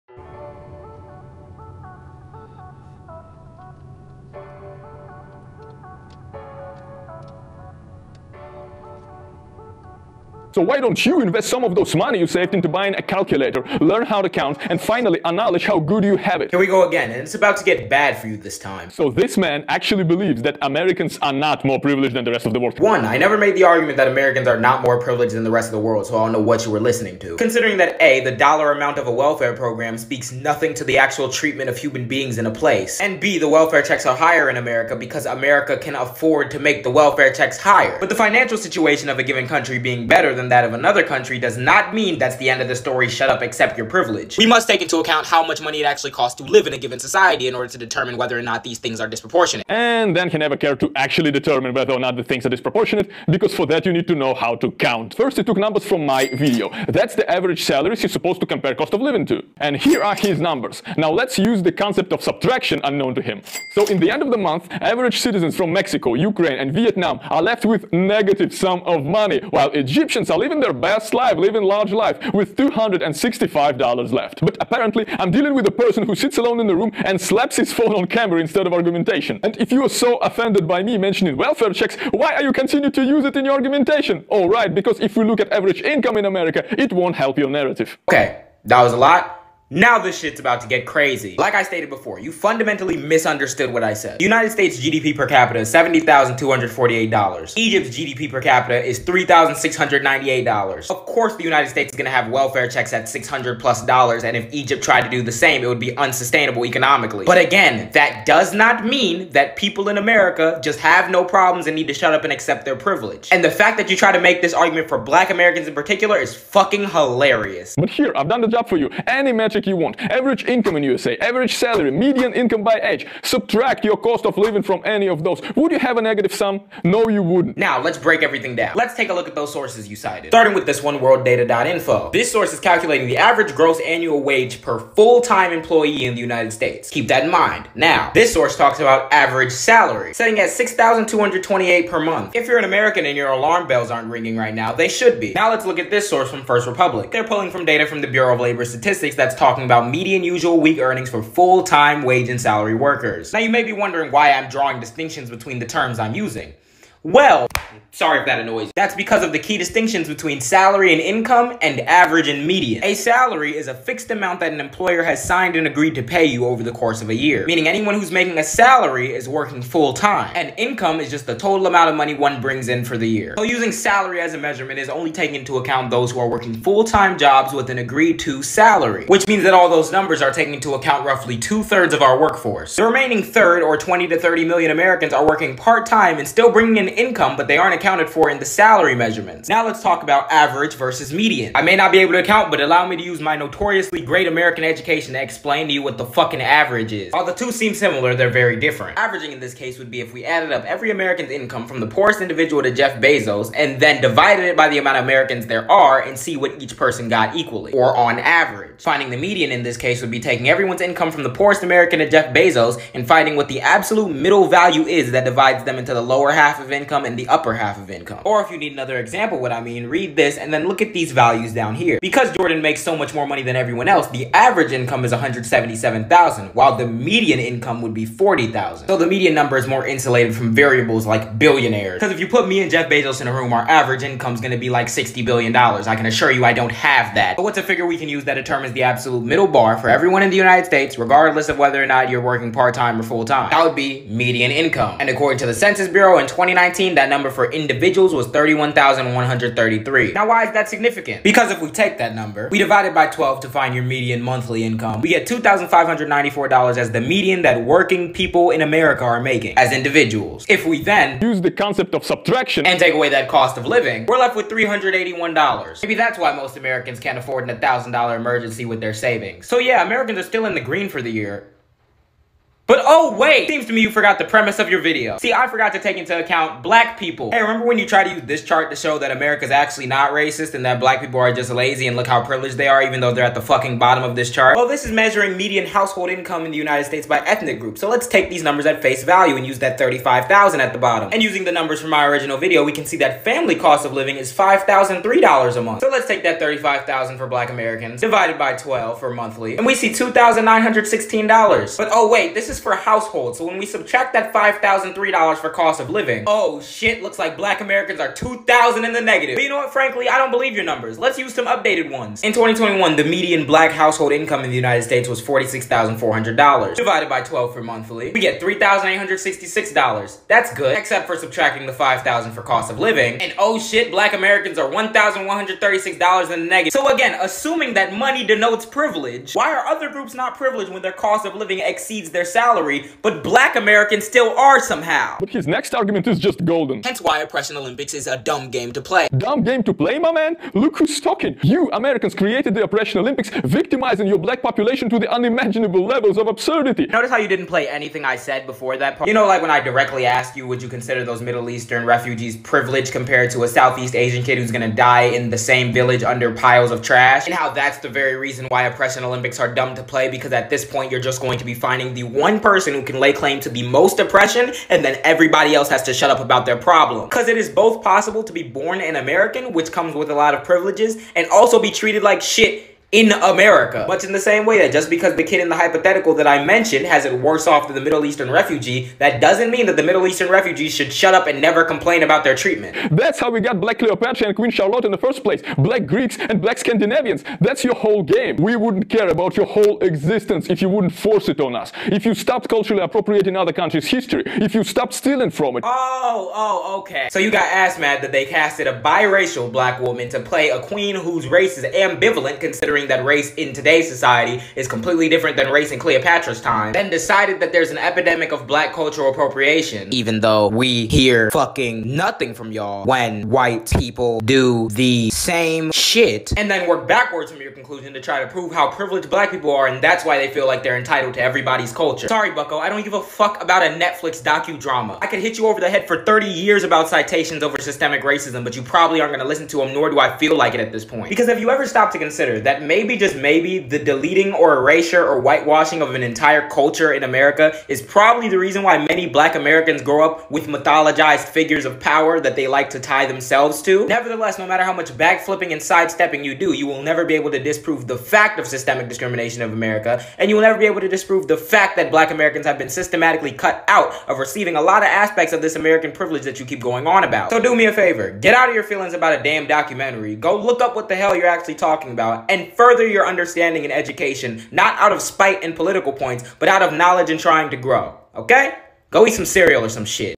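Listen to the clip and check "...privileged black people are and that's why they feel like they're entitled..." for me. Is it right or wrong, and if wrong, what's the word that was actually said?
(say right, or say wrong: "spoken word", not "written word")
right.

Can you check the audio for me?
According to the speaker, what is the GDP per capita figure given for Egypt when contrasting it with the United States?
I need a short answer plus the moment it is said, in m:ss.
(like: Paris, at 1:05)
$3,698, at 1:38.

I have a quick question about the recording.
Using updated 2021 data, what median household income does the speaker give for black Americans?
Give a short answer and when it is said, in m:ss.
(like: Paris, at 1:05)
$46,400, at 5:15.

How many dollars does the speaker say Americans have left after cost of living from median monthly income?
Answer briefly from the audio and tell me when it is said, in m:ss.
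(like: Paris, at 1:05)
$381, at 4:24.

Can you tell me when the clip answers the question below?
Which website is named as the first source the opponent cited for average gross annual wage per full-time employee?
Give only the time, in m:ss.
2:10.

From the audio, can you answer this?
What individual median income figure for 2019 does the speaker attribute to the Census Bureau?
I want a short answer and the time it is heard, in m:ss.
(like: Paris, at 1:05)
31,133, at 4:08.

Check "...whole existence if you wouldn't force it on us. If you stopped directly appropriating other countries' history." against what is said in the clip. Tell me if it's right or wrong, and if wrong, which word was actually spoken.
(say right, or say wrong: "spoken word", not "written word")
wrong: "culturally", not "directly".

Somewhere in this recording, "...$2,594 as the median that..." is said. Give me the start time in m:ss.
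4:15.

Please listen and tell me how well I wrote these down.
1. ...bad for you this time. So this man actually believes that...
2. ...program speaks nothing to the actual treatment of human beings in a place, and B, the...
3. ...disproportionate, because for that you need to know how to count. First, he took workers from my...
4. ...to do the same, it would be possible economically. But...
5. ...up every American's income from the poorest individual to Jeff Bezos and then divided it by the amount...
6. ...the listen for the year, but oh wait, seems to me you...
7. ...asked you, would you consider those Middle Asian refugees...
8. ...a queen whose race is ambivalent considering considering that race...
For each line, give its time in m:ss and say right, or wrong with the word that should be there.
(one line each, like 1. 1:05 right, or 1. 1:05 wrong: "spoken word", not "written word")
1. 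0:17 right
2. 0:29 right
3. 0:52 wrong: "numbers", not "workers"
4. 1:45 wrong: "unsustainable", not "possible"
5. 3:20 right
6. 4:30 wrong: "green", not "listen"
7. 5:50 wrong: "Eastern", not "Asian"
8. 6:40 right.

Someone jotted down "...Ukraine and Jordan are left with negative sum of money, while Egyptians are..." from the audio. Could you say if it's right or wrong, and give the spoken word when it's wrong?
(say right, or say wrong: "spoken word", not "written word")
wrong: "Vietnam", not "Jordan".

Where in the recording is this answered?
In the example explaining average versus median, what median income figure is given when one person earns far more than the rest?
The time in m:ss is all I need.
3:48.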